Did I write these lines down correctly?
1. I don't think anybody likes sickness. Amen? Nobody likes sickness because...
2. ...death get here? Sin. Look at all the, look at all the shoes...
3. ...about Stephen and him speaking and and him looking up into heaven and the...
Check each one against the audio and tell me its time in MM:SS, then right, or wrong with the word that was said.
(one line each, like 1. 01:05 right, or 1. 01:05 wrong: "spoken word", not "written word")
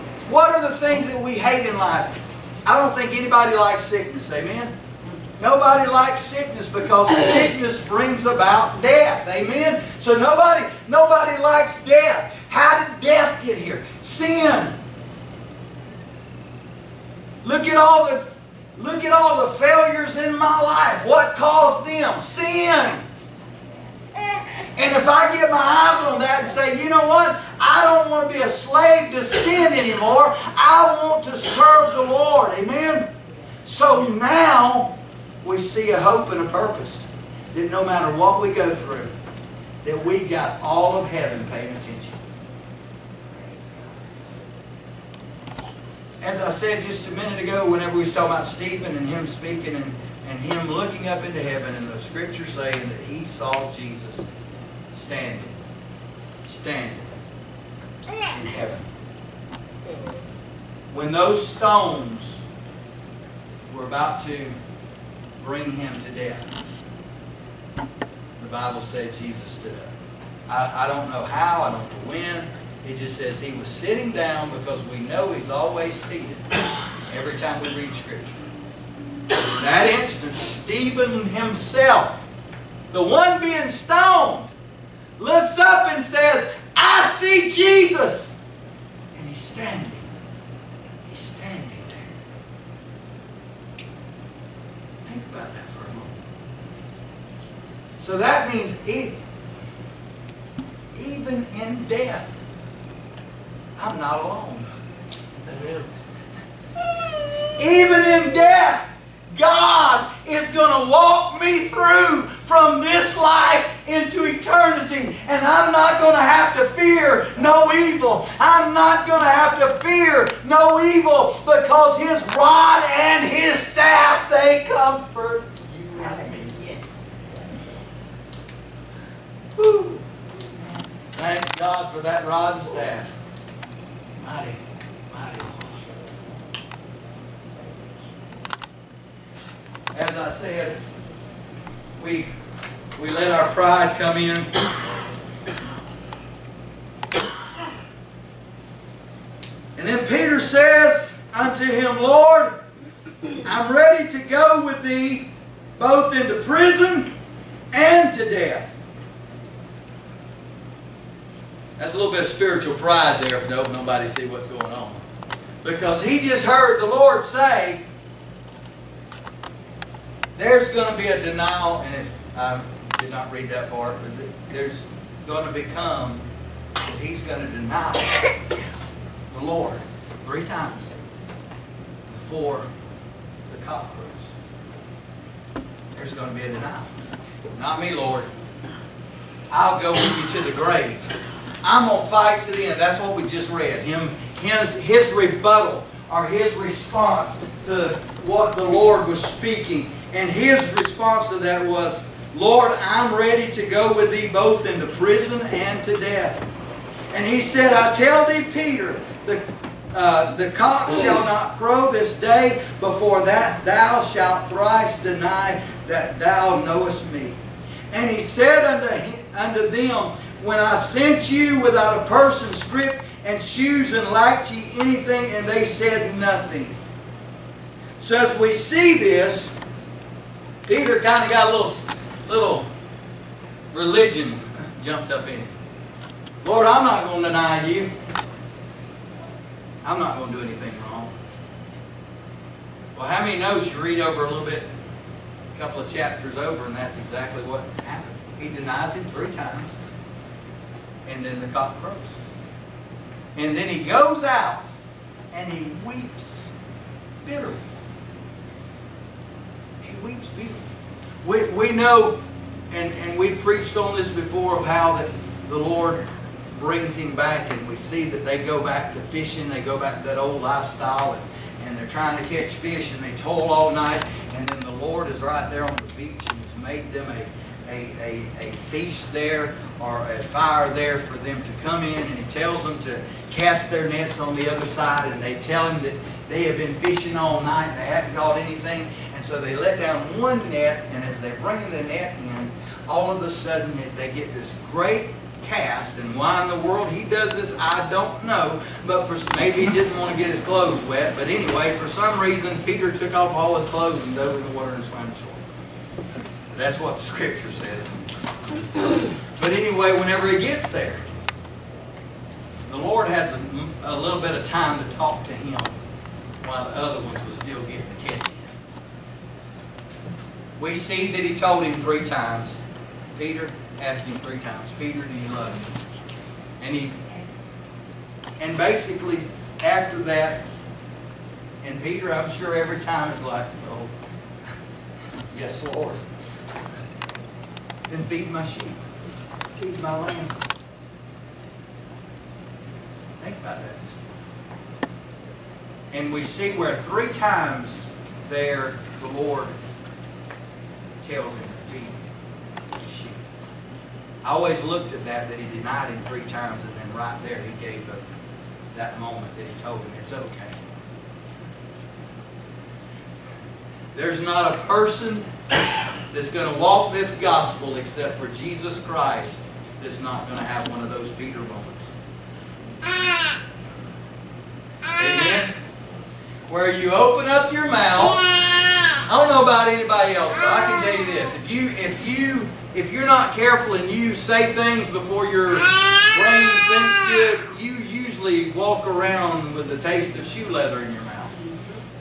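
1. 00:02 right
2. 00:12 wrong: "failures", not "shoes"
3. 00:48 right.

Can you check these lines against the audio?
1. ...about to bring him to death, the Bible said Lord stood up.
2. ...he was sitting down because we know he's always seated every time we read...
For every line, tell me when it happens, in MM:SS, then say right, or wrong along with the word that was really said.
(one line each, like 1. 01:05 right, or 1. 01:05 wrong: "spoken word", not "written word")
1. 01:03 wrong: "Jesus", not "Lord"
2. 01:13 right.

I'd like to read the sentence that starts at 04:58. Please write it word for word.
But for maybe he didn't want to get his clothes wet.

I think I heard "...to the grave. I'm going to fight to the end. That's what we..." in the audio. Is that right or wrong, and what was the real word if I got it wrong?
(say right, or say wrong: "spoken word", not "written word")
right.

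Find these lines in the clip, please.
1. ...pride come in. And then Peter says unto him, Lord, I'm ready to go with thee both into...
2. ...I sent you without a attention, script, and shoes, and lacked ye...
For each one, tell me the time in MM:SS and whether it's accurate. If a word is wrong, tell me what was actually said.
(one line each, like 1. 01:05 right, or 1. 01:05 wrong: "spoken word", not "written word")
1. 02:23 right
2. 03:40 wrong: "person", not "attention".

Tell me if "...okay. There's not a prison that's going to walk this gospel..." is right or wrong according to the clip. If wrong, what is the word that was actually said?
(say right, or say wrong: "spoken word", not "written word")
wrong: "person", not "prison".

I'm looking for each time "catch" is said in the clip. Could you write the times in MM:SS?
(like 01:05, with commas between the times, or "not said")
04:32, 05:18.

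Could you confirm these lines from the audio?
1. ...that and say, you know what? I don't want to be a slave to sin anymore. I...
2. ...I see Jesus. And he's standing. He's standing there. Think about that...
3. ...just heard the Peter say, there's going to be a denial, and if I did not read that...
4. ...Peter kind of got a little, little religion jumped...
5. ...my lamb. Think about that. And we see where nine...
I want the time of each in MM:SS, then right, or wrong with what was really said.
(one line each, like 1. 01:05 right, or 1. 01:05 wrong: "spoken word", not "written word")
1. 00:26 right
2. 01:26 right
3. 02:46 wrong: "Lord", not "Peter"
4. 03:50 right
5. 05:39 wrong: "three", not "nine".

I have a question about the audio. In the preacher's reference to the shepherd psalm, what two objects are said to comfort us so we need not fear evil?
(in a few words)
rod and staff.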